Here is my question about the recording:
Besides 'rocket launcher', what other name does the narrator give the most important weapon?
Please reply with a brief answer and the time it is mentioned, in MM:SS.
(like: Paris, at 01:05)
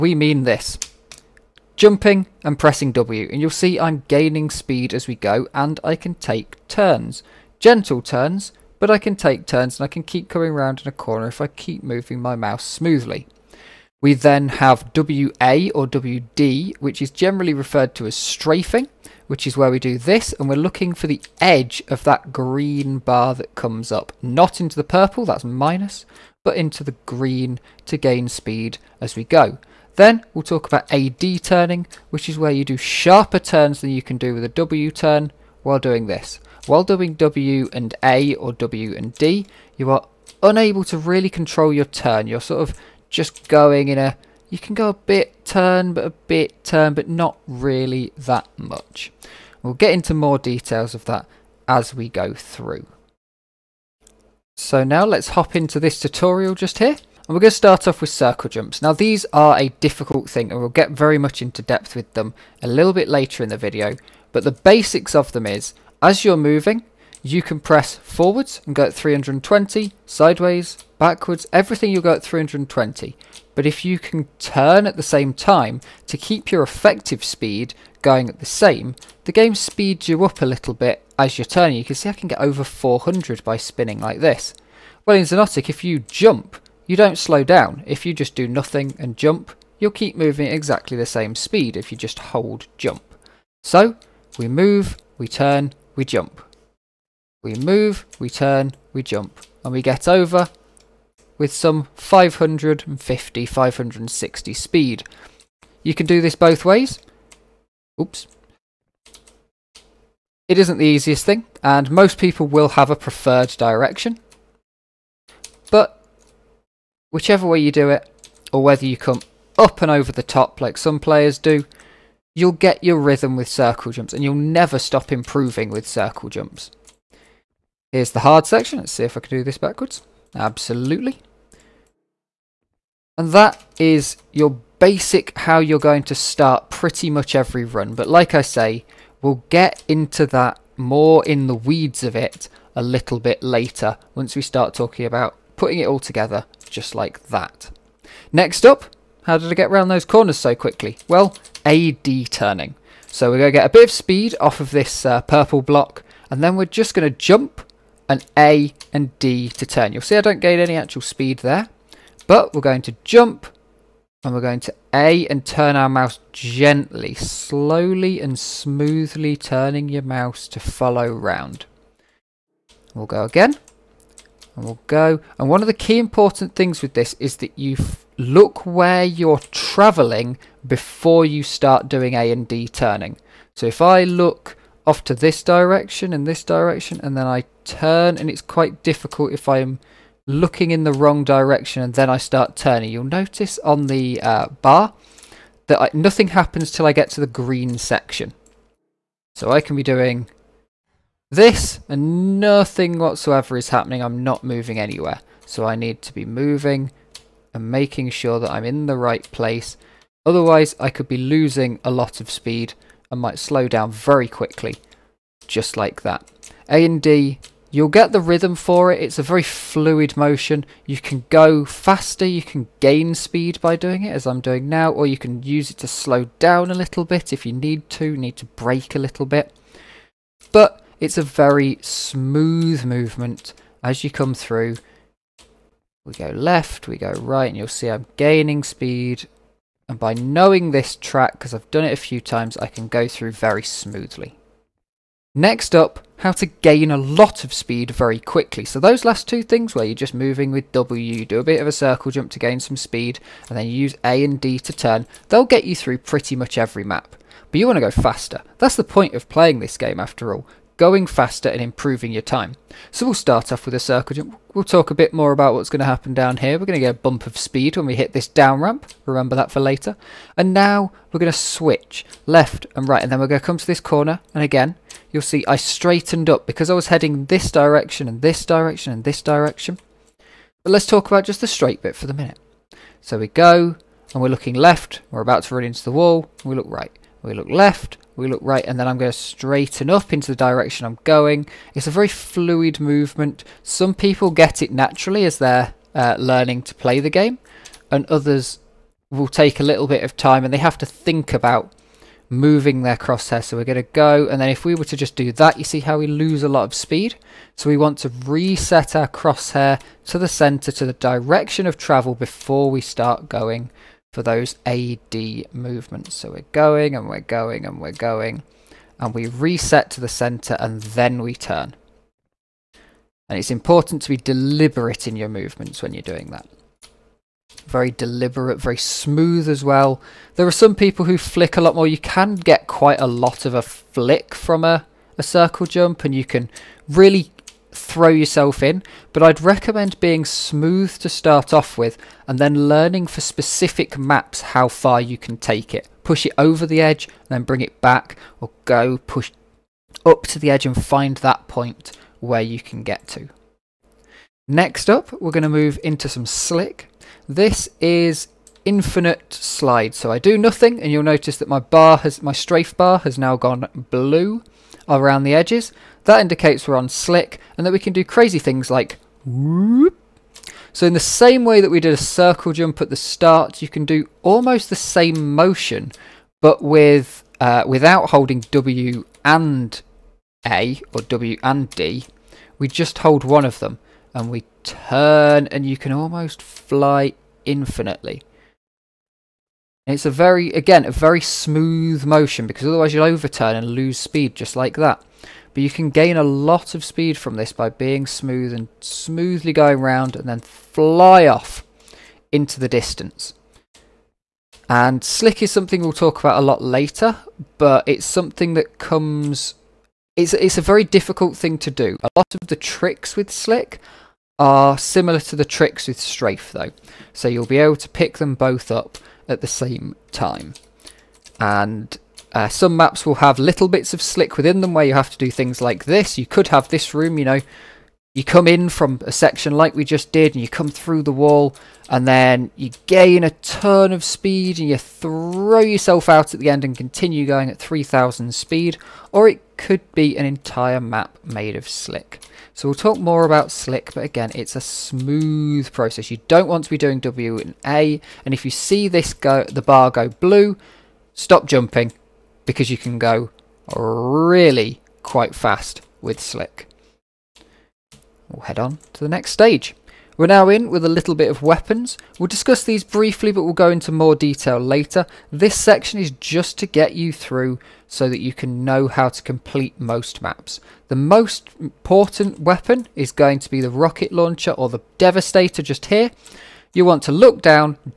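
Devastator, at 07:54.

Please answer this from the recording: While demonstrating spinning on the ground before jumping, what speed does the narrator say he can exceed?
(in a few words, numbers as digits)
400.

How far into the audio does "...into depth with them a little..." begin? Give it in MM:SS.
01:01.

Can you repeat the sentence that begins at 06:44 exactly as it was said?
And slick is something we'll talk about a lot later, but it's something that comes...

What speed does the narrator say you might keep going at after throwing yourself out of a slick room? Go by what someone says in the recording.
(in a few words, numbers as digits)
3000.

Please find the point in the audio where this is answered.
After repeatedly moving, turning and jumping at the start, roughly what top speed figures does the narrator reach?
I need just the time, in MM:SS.
01:41.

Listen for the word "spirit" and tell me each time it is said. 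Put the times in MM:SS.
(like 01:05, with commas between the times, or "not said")
not said.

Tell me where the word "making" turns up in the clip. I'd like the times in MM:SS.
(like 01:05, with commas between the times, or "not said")
03:27.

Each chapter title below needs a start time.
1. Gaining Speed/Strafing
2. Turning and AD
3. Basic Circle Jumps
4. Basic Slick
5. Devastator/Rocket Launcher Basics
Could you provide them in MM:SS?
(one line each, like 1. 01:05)
1. 04:04
2. 02:27
3. 00:53
4. 05:53
5. 07:40.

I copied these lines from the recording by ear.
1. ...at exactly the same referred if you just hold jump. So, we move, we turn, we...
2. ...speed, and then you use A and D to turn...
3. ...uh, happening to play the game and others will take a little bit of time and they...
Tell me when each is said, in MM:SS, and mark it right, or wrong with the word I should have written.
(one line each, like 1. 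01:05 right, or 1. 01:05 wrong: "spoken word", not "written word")
1. 01:30 wrong: "speed", not "referred"
2. 04:12 right
3. 04:55 wrong: "learning", not "happening".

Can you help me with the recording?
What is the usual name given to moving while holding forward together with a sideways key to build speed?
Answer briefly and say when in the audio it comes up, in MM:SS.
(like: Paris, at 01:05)
Strafing, at 00:18.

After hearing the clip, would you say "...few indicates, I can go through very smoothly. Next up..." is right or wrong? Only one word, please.
wrong.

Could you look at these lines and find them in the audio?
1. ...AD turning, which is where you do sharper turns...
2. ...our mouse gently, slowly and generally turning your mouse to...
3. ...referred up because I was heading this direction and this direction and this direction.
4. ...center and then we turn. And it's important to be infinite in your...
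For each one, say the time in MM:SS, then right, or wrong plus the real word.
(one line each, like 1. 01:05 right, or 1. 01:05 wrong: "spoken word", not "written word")
1. 00:30 right
2. 02:45 wrong: "smoothly", not "generally"
3. 04:35 wrong: "straightened", not "referred"
4. 05:20 wrong: "deliberate", not "infinite".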